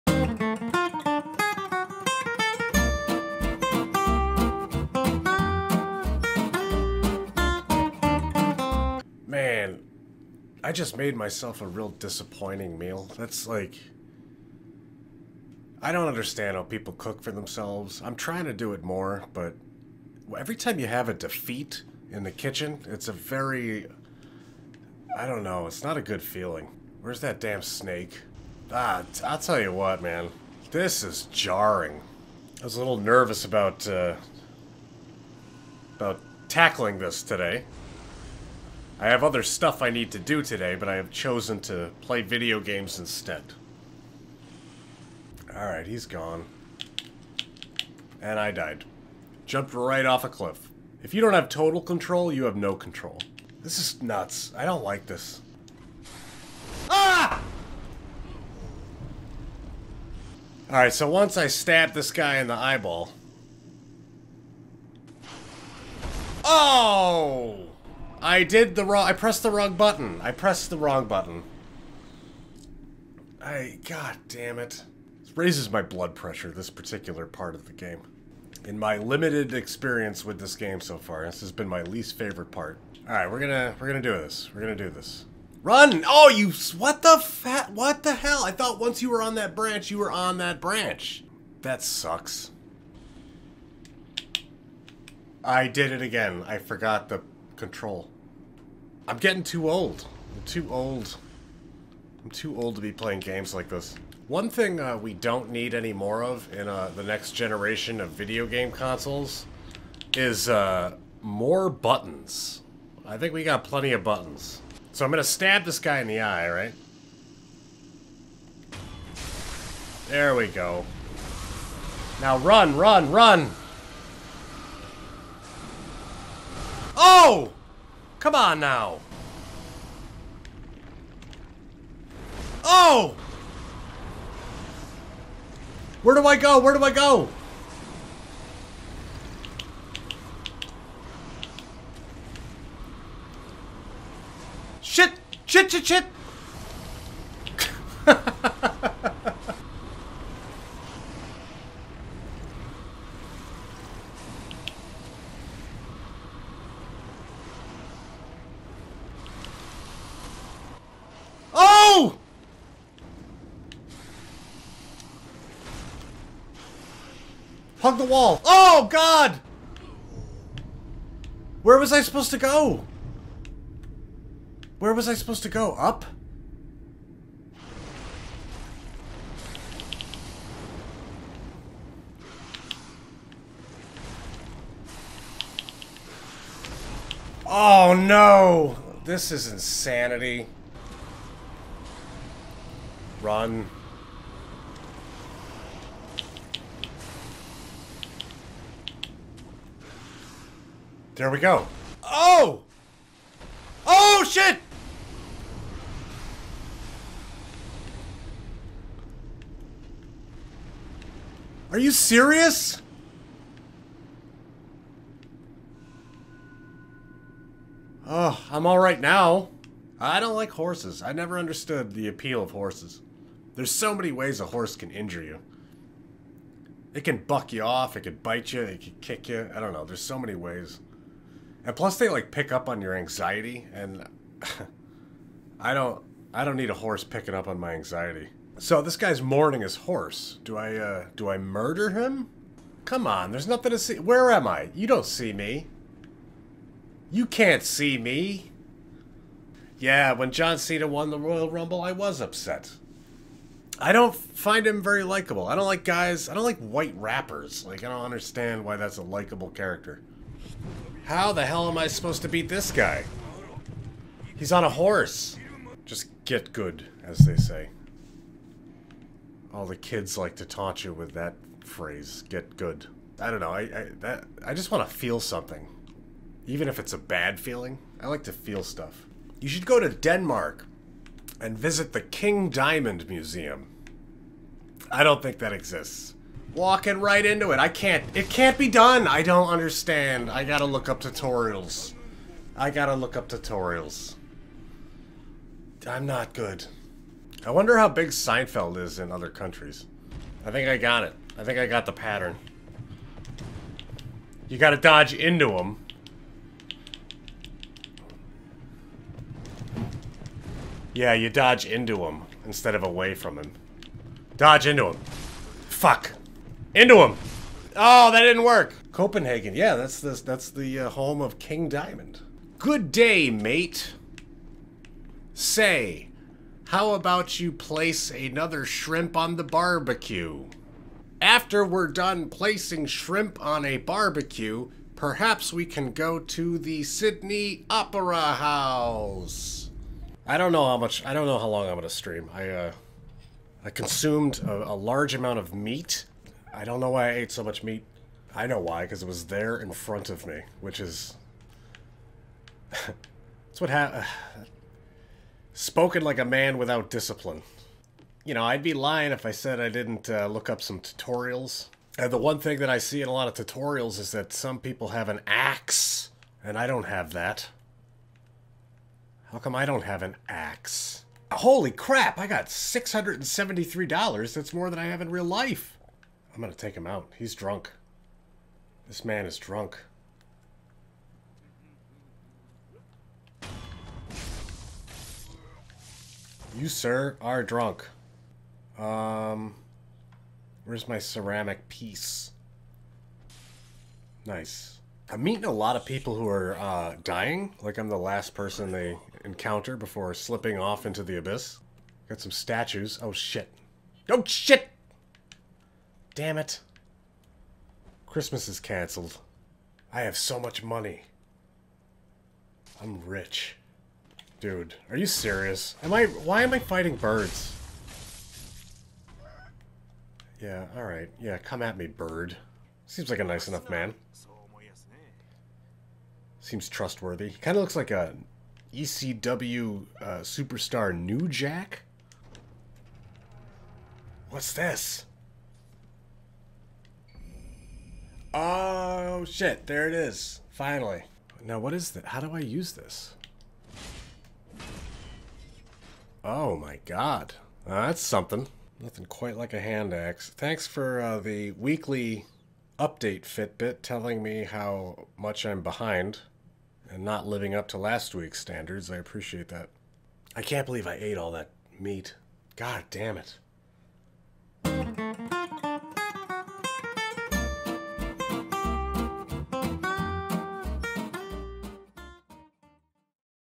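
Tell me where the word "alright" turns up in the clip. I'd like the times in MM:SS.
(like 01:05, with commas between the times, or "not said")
00:45, 01:00, 01:23, 03:38, 07:00.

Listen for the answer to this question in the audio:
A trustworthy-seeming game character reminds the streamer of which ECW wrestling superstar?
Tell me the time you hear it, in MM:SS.
07:10.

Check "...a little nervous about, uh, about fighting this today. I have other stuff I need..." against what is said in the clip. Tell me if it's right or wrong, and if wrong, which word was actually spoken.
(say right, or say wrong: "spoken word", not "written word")
wrong: "tackling", not "fighting".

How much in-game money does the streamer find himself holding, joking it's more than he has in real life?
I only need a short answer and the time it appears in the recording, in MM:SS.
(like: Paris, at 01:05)
$673, at 06:12.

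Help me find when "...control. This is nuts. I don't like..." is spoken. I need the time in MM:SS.
00:52.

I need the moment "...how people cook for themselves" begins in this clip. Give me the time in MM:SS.
00:16.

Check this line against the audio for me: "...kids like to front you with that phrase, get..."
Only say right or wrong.
wrong.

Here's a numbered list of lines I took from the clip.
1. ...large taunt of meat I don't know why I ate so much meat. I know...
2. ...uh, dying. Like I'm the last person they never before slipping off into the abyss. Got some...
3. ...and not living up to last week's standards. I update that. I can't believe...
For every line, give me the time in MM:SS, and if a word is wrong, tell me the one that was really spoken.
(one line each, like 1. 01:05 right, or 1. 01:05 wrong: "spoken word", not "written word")
1. 05:44 wrong: "amount", not "taunt"
2. 06:36 wrong: "encounter", not "never"
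3. 07:36 wrong: "appreciate", not "update".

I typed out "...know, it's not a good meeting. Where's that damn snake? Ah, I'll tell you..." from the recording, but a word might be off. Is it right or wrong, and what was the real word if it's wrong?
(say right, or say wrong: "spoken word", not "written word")
wrong: "feeling", not "meeting".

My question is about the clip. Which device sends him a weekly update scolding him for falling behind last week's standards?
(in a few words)
Fitbit.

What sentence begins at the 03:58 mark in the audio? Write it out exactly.
So this guy's mourning his horse.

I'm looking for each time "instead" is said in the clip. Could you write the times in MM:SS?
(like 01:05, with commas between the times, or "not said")
00:42, 05:12.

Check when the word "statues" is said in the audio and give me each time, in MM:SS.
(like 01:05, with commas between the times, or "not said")
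06:42.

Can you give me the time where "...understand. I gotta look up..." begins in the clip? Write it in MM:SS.
04:49.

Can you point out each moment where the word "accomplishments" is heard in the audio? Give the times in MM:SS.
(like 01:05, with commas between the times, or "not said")
not said.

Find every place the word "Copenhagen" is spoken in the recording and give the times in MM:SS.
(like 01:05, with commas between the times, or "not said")
05:18.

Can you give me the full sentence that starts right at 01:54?
So I'm going to stab this guy in the eye, right?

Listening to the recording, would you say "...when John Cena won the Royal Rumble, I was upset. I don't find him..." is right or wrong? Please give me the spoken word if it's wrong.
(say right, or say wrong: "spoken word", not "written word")
right.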